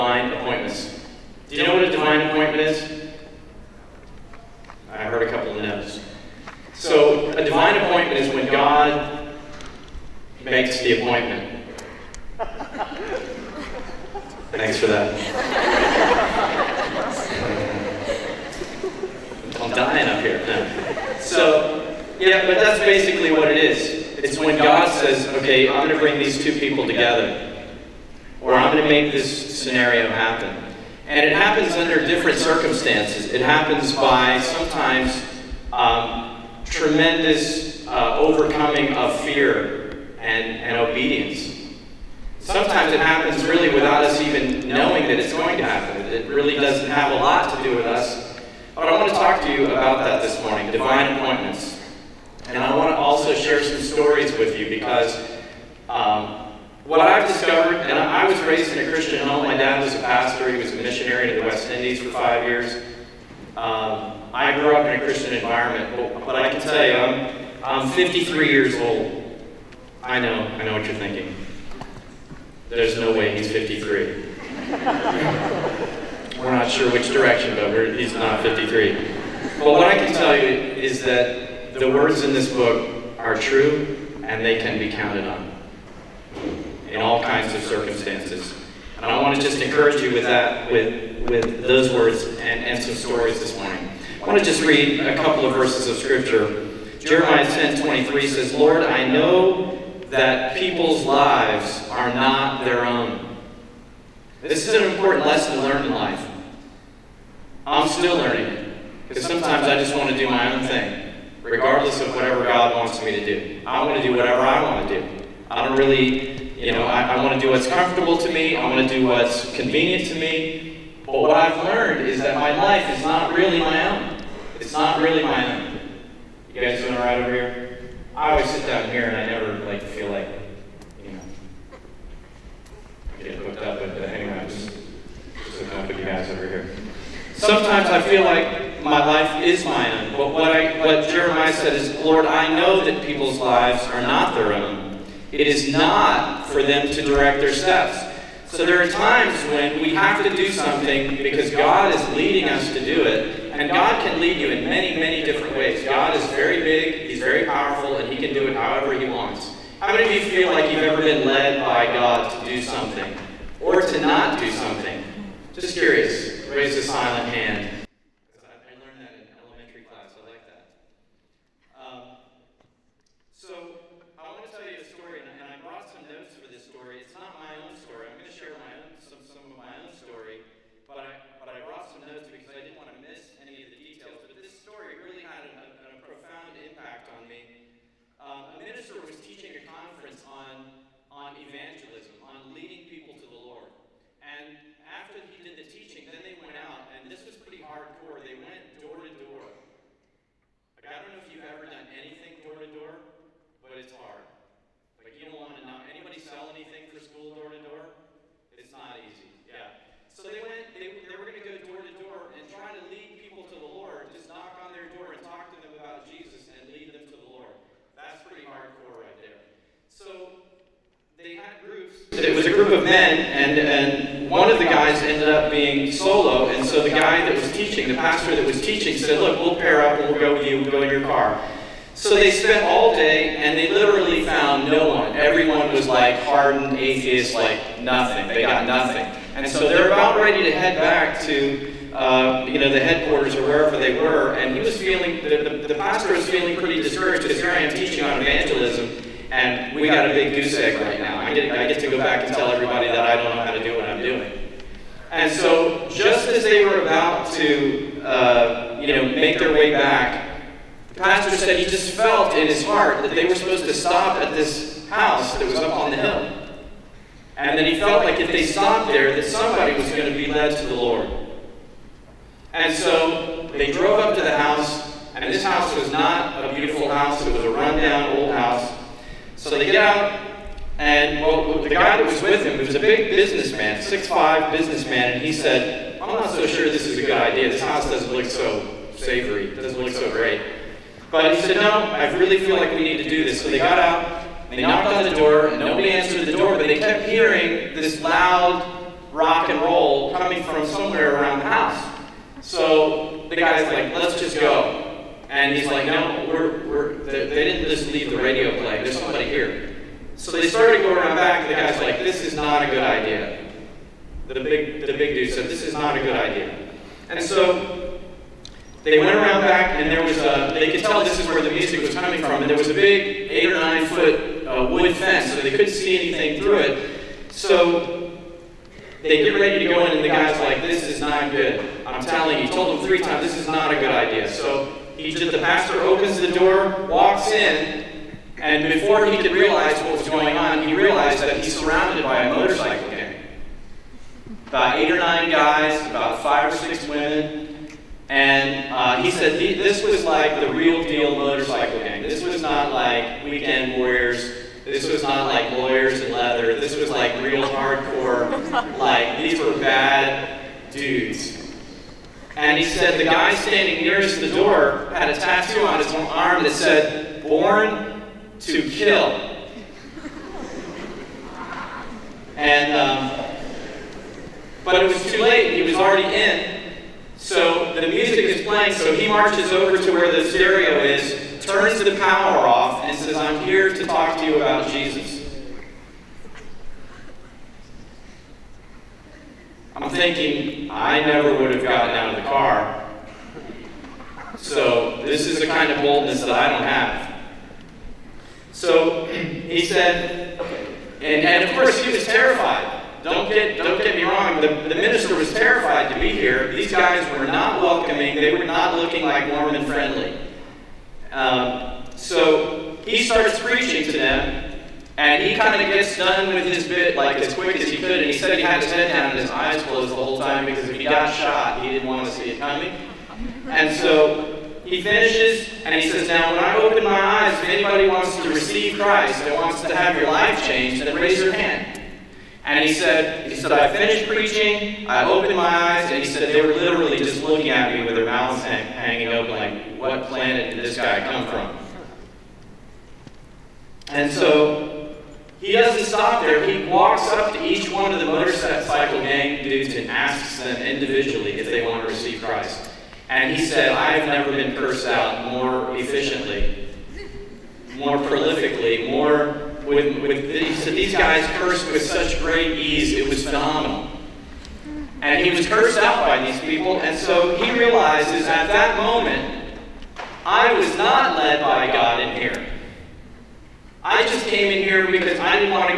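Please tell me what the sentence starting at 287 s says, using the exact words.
This house doesn't look so savory.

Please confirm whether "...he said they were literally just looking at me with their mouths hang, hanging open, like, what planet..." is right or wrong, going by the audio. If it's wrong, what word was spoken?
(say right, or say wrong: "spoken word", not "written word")
right.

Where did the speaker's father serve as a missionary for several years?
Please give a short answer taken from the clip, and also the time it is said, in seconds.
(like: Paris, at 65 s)
West Indies, at 61 s.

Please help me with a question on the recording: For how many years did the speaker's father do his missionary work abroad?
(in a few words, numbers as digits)
5.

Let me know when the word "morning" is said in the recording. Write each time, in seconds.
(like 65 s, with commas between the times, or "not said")
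50 s, 93 s.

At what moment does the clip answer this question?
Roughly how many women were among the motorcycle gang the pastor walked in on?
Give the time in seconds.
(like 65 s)
346 s.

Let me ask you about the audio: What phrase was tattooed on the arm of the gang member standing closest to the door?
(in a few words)
Born to Kill.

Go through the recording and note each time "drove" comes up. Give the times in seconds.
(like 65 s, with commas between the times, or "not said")
273 s.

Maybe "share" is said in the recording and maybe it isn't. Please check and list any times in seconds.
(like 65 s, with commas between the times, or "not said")
53 s, 178 s.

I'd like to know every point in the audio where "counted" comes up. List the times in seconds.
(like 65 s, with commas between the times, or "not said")
84 s.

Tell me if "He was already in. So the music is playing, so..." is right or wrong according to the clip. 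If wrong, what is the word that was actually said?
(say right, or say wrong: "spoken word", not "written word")
right.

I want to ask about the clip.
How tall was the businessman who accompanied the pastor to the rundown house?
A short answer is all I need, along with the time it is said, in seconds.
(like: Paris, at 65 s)
6'5", at 283 s.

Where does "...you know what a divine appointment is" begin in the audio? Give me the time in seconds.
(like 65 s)
1 s.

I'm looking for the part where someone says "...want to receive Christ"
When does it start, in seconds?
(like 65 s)
451 s.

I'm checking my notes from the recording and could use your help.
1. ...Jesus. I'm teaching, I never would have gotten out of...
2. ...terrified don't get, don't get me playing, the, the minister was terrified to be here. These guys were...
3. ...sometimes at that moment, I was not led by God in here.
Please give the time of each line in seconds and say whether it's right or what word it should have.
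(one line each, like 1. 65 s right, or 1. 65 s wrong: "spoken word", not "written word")
1. 384 s wrong: "thinking", not "teaching"
2. 402 s wrong: "wrong", not "playing"
3. 467 s wrong: "realizes", not "sometimes".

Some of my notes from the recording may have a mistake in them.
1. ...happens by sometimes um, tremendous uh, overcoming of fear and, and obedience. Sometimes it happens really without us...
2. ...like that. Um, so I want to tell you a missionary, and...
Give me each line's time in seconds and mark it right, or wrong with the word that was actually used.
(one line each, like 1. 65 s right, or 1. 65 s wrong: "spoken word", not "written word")
1. 33 s right
2. 170 s wrong: "story", not "missionary".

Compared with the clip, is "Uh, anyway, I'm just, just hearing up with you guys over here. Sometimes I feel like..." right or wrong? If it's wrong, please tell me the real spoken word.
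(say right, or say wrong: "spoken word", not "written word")
wrong: "hooking", not "hearing".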